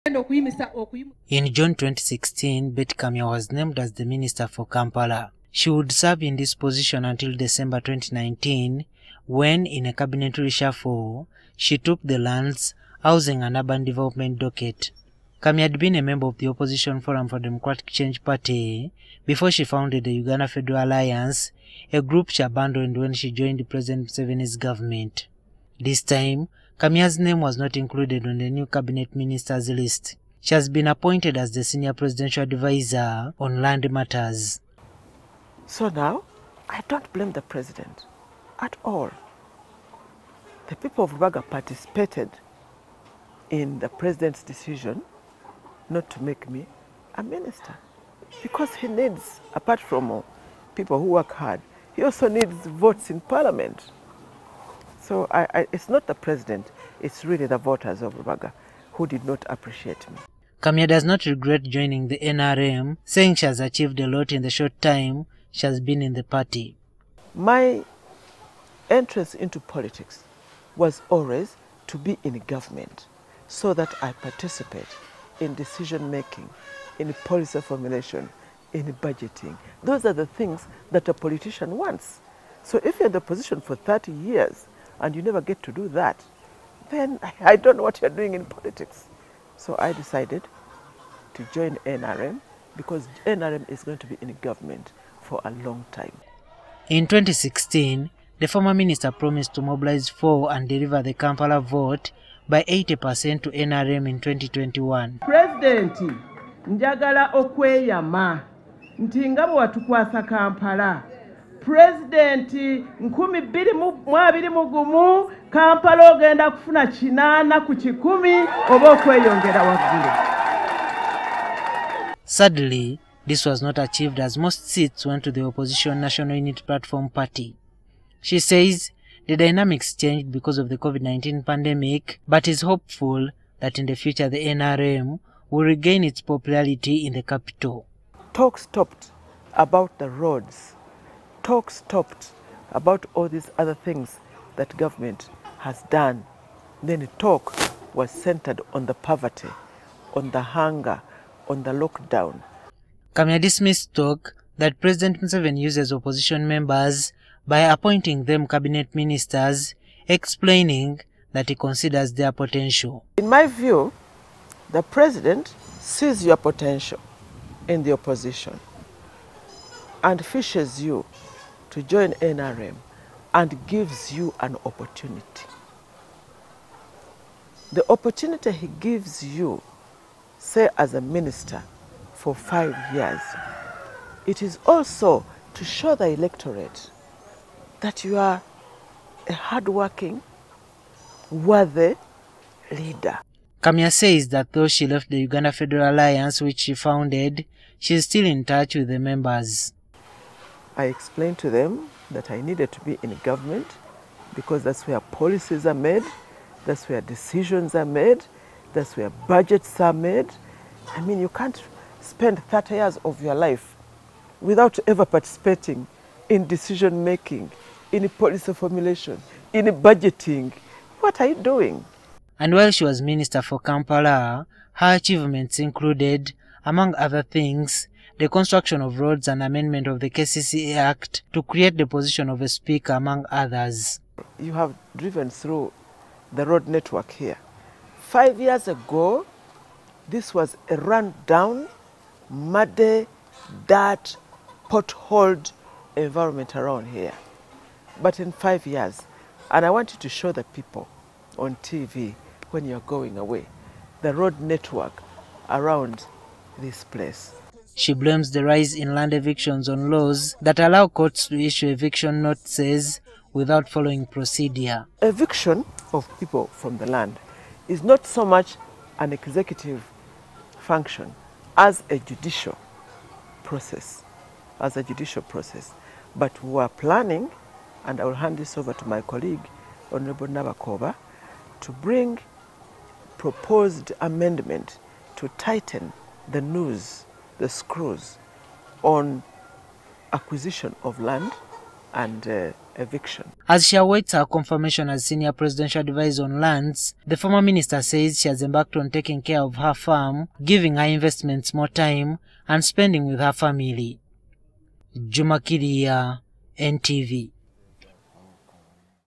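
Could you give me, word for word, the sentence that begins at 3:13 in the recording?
Kamya says that though she left the Uganda Federal Alliance, which she founded, she is still in touch with the members.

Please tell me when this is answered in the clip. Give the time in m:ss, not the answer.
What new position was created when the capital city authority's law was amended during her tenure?
3:52.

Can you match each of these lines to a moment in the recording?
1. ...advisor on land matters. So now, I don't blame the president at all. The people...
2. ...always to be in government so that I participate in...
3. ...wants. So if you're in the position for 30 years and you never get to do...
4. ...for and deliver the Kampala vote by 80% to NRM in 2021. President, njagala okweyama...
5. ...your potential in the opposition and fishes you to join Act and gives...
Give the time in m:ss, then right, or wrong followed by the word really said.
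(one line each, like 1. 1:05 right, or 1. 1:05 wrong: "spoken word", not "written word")
1. 0:32 right
2. 1:11 right
3. 1:21 right
4. 1:40 right
5. 2:46 wrong: "NRM", not "Act".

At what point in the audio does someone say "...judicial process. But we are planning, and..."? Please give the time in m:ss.
4:34.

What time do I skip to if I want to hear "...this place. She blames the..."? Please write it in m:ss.
4:16.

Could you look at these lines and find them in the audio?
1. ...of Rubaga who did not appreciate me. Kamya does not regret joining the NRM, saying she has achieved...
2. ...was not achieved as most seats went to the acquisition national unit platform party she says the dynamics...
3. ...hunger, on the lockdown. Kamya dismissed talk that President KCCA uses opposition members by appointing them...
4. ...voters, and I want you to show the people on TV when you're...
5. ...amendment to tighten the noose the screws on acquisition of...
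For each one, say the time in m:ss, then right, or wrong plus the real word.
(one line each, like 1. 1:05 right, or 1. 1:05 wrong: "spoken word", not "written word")
1. 0:58 right
2. 2:03 wrong: "opposition", not "acquisition"
3. 2:30 wrong: "Museveni", not "KCCA"
4. 4:08 wrong: "years", not "voters"
5. 4:44 right.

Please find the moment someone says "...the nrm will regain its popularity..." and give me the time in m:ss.
2:14.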